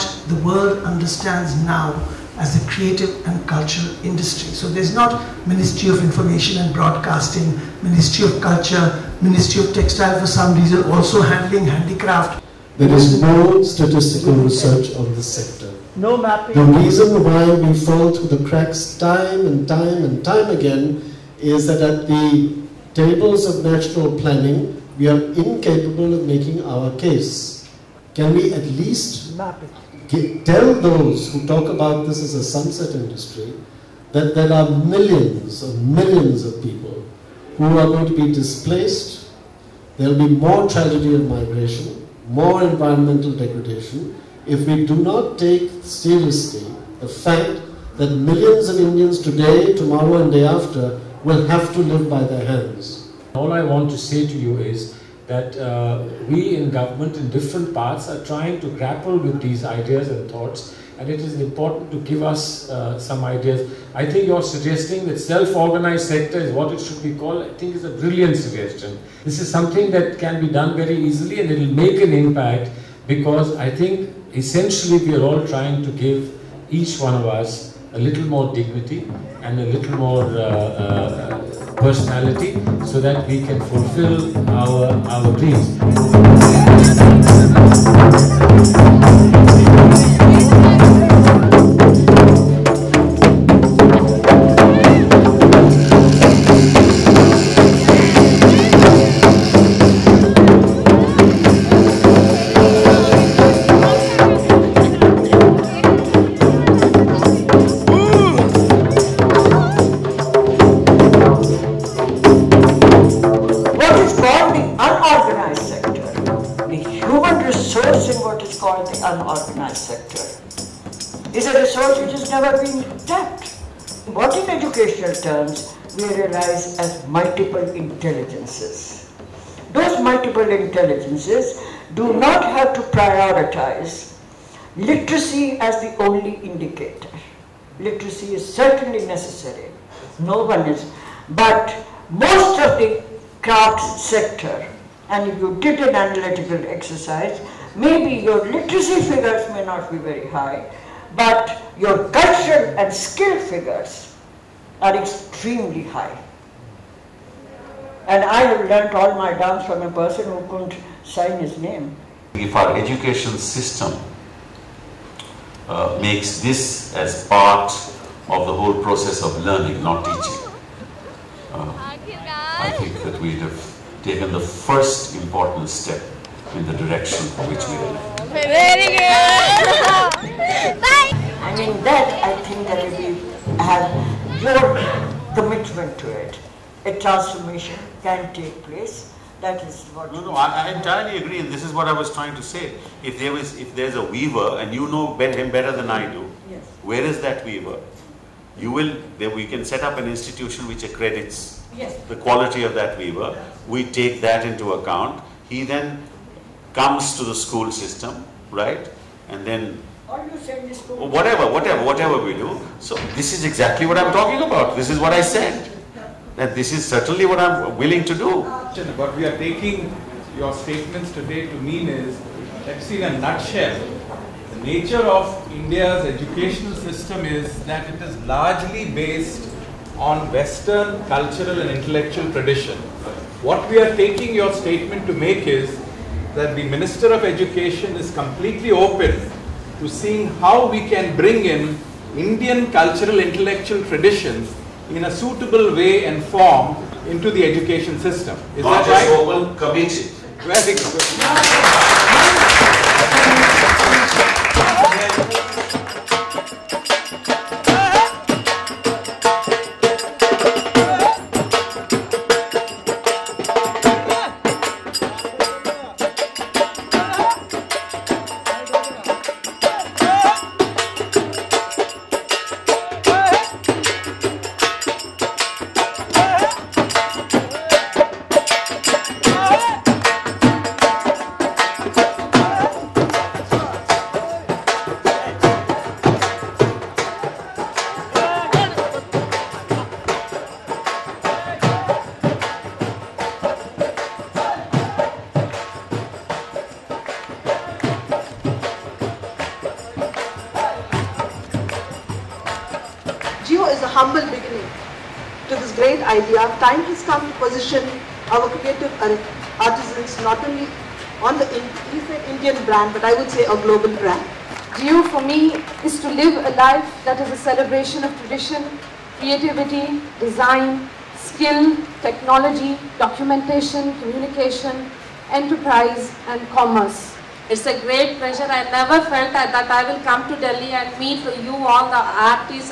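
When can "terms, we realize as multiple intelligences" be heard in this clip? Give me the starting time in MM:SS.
02:05.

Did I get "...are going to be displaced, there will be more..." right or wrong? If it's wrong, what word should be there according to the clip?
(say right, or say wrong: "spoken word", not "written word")
right.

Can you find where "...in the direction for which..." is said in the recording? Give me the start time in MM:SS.
02:56.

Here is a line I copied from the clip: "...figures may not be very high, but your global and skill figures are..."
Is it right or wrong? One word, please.
wrong.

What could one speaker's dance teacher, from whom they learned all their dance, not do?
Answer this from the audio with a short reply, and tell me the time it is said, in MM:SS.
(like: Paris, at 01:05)
sign his name, at 02:40.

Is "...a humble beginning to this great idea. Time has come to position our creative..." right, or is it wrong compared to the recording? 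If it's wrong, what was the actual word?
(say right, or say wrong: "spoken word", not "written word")
right.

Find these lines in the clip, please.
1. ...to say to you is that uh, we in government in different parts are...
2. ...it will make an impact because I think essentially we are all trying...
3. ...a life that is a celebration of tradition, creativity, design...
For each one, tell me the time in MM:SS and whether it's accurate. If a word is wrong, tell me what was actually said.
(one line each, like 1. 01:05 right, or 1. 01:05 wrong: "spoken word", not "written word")
1. 00:53 right
2. 01:11 right
3. 05:16 right.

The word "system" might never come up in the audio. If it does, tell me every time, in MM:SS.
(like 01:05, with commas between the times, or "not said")
02:43, 03:27, 03:46, 04:07.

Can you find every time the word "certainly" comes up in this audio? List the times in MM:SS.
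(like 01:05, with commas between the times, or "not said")
02:18, 03:36.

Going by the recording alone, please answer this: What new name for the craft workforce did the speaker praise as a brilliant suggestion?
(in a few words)
self-organized sector.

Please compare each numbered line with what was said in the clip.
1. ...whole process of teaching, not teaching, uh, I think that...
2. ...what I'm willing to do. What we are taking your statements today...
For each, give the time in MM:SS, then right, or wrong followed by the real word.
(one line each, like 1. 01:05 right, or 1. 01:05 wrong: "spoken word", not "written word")
1. 02:48 wrong: "learning", not "teaching"
2. 03:37 right.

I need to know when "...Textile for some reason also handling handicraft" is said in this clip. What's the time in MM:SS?
00:09.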